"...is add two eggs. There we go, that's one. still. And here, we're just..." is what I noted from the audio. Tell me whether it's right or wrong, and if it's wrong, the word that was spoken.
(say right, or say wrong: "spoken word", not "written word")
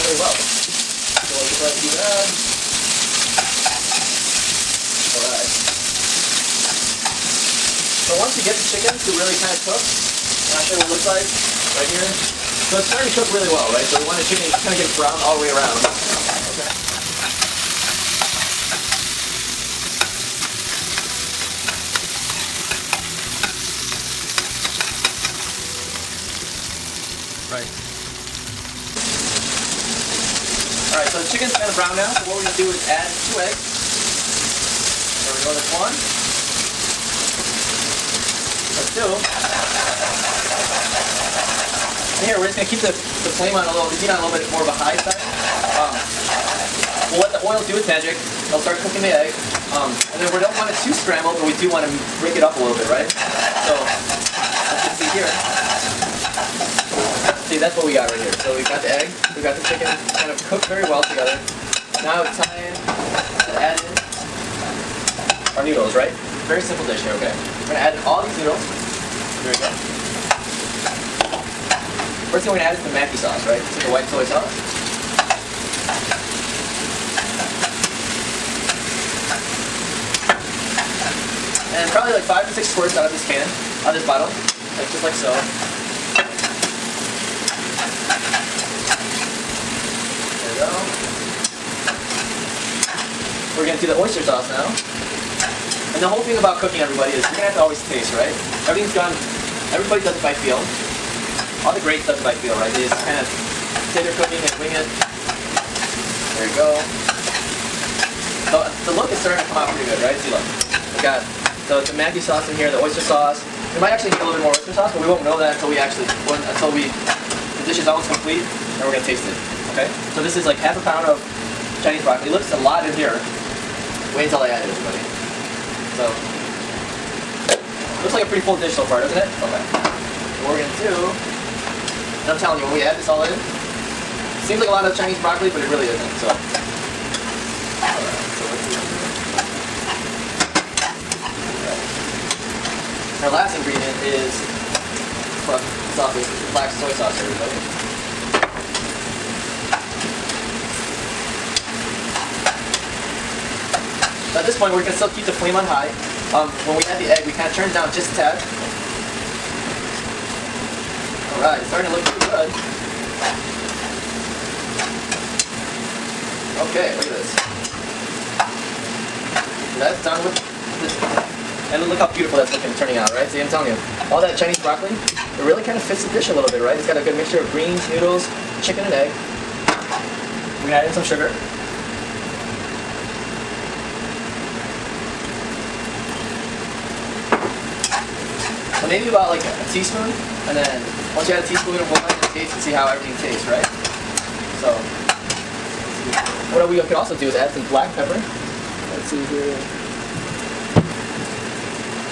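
right.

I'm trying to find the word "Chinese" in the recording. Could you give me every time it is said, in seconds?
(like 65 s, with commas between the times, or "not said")
121 s, 134 s, 174 s.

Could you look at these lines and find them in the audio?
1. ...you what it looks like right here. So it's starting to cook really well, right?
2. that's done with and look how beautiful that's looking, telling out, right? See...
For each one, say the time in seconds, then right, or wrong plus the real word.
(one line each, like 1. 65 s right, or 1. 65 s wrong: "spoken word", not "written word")
1. 10 s right
2. 169 s wrong: "turning", not "telling".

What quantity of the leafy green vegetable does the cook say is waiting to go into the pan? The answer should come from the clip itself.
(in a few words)
half a pound.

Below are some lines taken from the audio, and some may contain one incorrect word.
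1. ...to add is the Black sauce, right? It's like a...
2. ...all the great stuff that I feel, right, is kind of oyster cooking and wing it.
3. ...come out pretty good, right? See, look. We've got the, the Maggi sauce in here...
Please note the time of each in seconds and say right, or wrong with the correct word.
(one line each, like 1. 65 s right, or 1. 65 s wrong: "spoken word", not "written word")
1. 72 s wrong: "Maggi", not "Black"
2. 101 s wrong: "tender", not "oyster"
3. 109 s right.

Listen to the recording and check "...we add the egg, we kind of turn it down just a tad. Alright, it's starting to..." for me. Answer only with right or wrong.
right.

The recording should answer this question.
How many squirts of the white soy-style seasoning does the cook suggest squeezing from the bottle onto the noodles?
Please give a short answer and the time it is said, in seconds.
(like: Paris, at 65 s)
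5 to 6, at 82 s.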